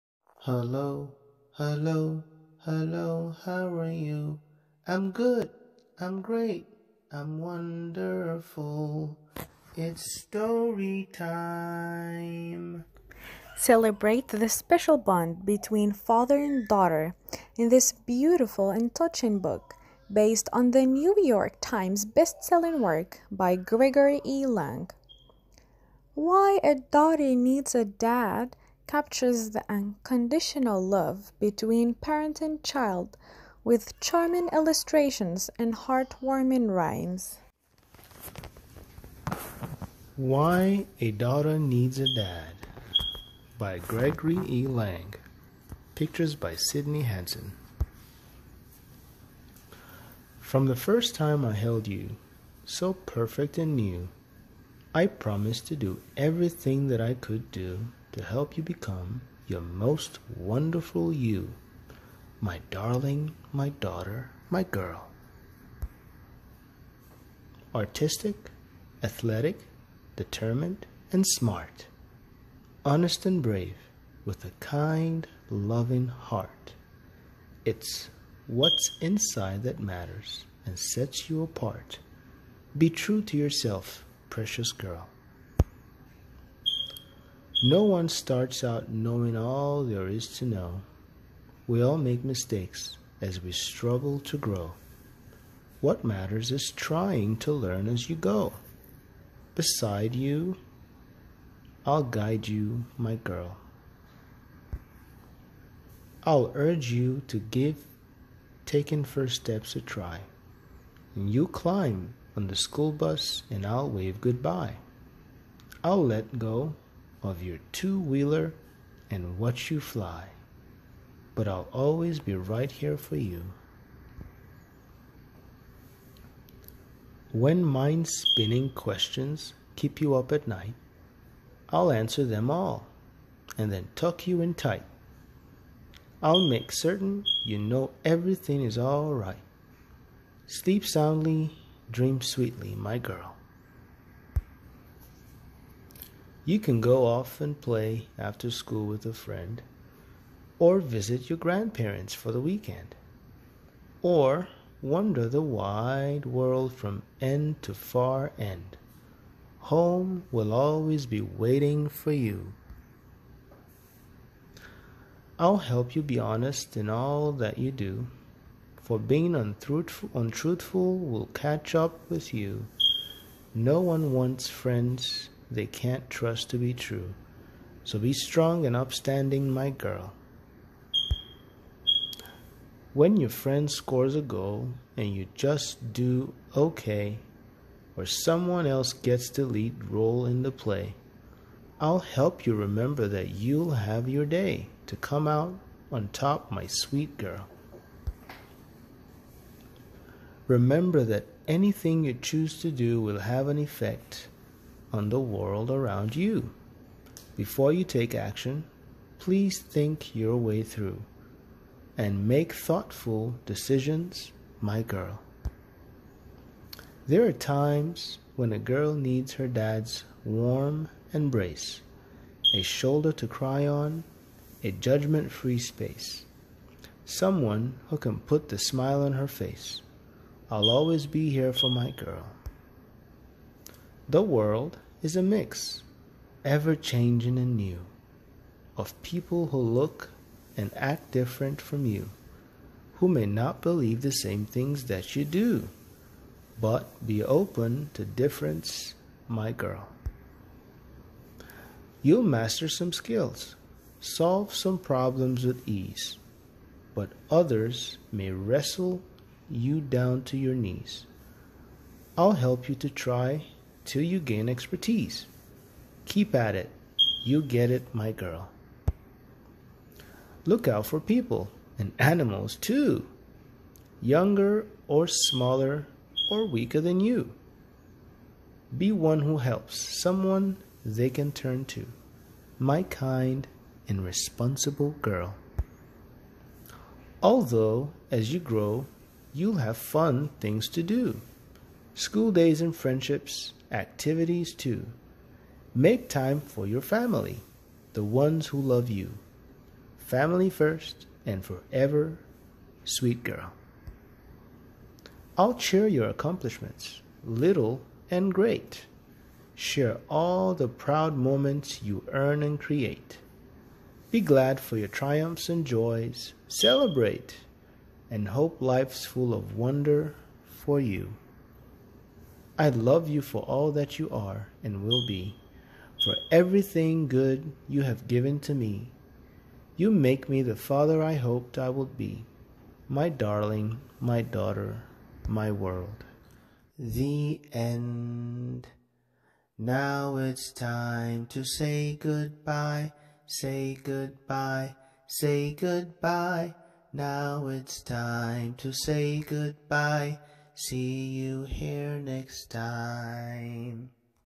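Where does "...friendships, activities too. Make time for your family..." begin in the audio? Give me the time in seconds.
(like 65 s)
292 s.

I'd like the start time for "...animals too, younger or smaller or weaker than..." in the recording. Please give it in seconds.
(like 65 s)
271 s.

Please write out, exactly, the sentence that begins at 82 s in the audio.
Be true to yourself, precious girl.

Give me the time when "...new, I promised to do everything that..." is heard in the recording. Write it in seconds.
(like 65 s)
53 s.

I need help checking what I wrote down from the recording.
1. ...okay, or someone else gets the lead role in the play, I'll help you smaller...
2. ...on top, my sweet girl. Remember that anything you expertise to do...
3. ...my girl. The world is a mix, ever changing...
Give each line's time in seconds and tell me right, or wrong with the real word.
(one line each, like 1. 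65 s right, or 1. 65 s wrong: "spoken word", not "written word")
1. 186 s wrong: "remember", not "smaller"
2. 195 s wrong: "choose", not "expertise"
3. 231 s right.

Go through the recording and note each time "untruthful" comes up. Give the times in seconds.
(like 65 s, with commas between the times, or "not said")
169 s.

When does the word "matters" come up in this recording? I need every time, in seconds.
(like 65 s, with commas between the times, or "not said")
79 s, 96 s.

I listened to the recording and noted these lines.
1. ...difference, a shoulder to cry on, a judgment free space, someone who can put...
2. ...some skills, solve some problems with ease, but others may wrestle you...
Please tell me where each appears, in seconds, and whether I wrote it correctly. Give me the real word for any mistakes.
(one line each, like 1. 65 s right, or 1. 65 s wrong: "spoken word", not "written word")
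1. 221 s wrong: "embrace", not "difference"
2. 252 s right.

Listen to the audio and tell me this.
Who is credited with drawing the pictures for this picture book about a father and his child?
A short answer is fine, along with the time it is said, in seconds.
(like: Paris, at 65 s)
Sydney Hanson, at 46 s.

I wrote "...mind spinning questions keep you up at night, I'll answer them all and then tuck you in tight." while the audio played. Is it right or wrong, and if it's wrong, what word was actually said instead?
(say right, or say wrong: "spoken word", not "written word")
right.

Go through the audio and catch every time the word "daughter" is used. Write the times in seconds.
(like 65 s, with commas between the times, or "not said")
16 s, 26 s, 41 s, 63 s, 334 s.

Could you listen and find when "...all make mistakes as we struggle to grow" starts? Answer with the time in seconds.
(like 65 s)
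91 s.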